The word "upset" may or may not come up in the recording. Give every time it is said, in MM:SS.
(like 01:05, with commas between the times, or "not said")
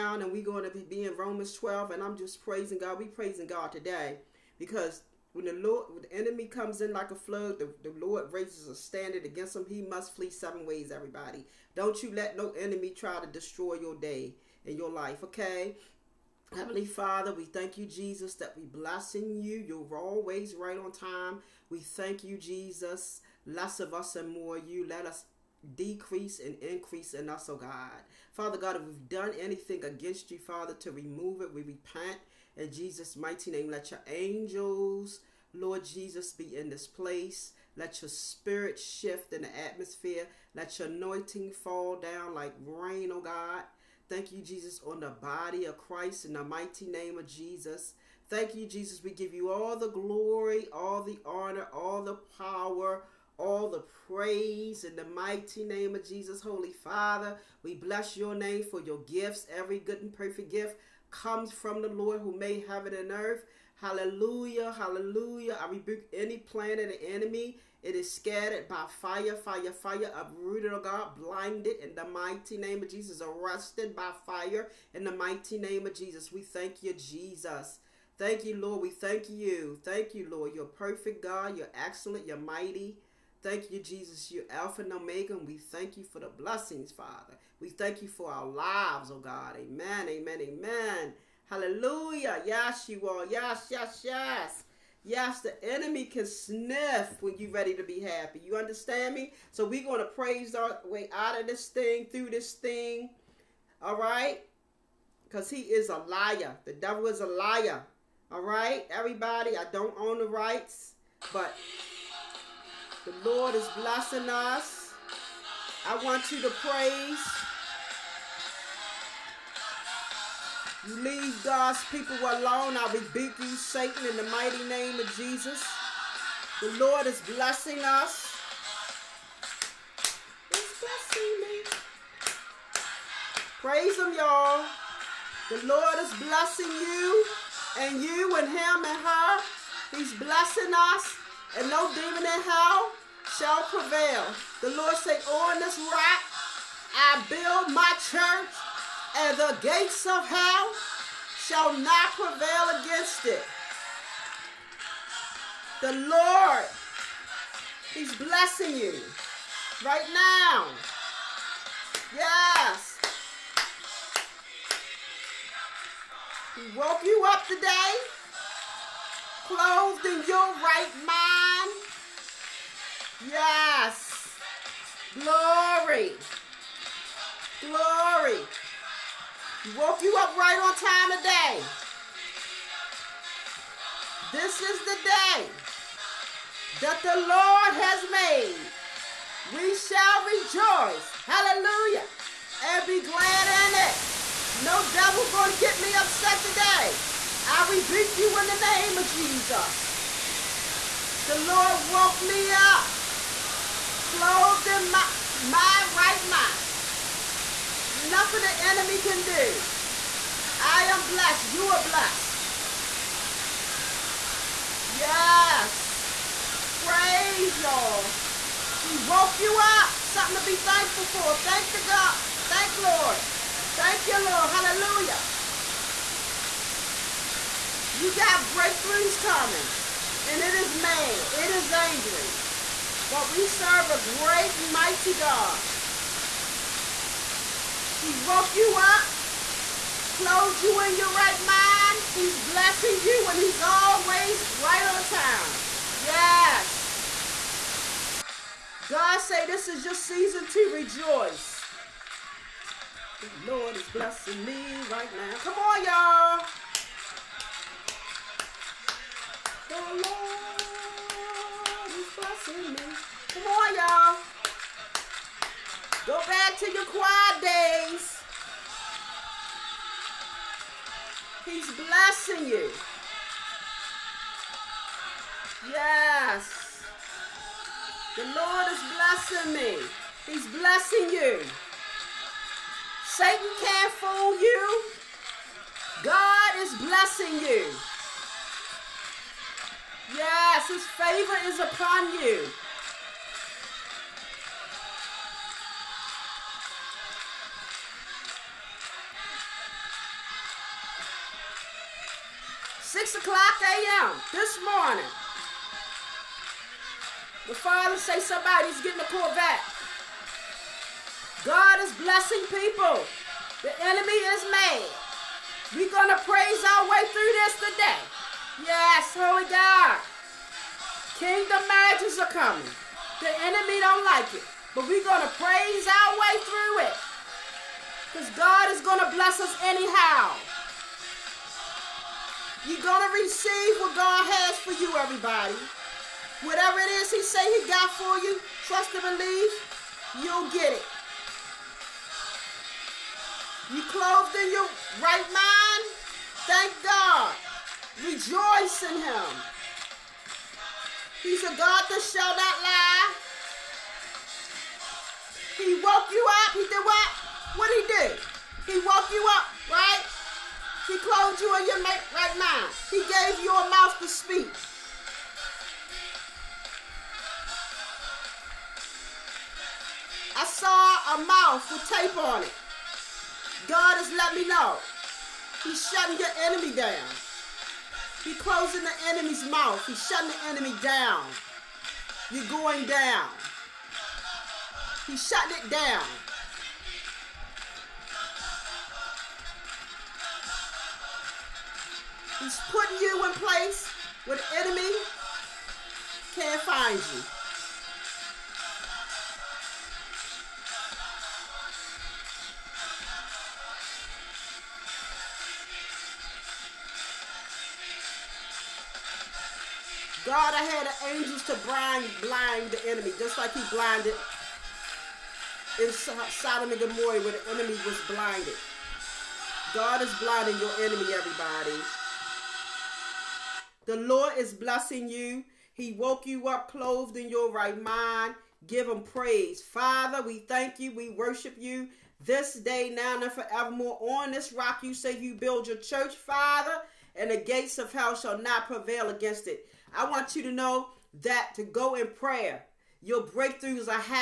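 03:15.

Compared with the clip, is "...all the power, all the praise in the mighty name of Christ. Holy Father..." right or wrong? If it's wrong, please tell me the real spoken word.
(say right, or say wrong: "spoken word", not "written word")
wrong: "Jesus", not "Christ".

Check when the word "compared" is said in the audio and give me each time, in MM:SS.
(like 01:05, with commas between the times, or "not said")
not said.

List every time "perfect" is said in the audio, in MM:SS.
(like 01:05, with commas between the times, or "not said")
01:00, 01:20.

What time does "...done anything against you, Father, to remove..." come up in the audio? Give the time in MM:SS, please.
00:29.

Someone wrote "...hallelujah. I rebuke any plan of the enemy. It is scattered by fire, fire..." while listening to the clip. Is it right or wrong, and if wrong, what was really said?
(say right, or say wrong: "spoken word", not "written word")
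right.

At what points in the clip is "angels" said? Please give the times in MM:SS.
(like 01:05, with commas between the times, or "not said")
00:34, 06:51.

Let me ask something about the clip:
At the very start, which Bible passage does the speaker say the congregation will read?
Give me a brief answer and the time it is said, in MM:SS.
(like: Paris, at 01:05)
Romans 12, at 00:01.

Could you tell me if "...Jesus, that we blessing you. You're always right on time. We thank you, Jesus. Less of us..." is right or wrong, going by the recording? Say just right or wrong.
right.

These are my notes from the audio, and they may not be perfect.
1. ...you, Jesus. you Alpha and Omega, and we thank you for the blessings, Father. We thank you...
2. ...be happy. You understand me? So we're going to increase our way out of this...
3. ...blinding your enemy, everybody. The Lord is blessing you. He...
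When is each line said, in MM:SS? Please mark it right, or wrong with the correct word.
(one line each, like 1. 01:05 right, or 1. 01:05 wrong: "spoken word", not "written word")
1. 01:23 right
2. 01:37 wrong: "praise", not "increase"
3. 07:00 right.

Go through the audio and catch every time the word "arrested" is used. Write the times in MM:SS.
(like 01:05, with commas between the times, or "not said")
01:13.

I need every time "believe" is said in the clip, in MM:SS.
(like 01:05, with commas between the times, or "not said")
05:39.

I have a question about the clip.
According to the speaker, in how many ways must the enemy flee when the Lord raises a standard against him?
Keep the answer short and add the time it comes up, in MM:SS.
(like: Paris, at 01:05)
7, at 00:10.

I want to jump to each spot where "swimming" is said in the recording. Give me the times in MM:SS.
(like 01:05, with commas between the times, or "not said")
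04:22.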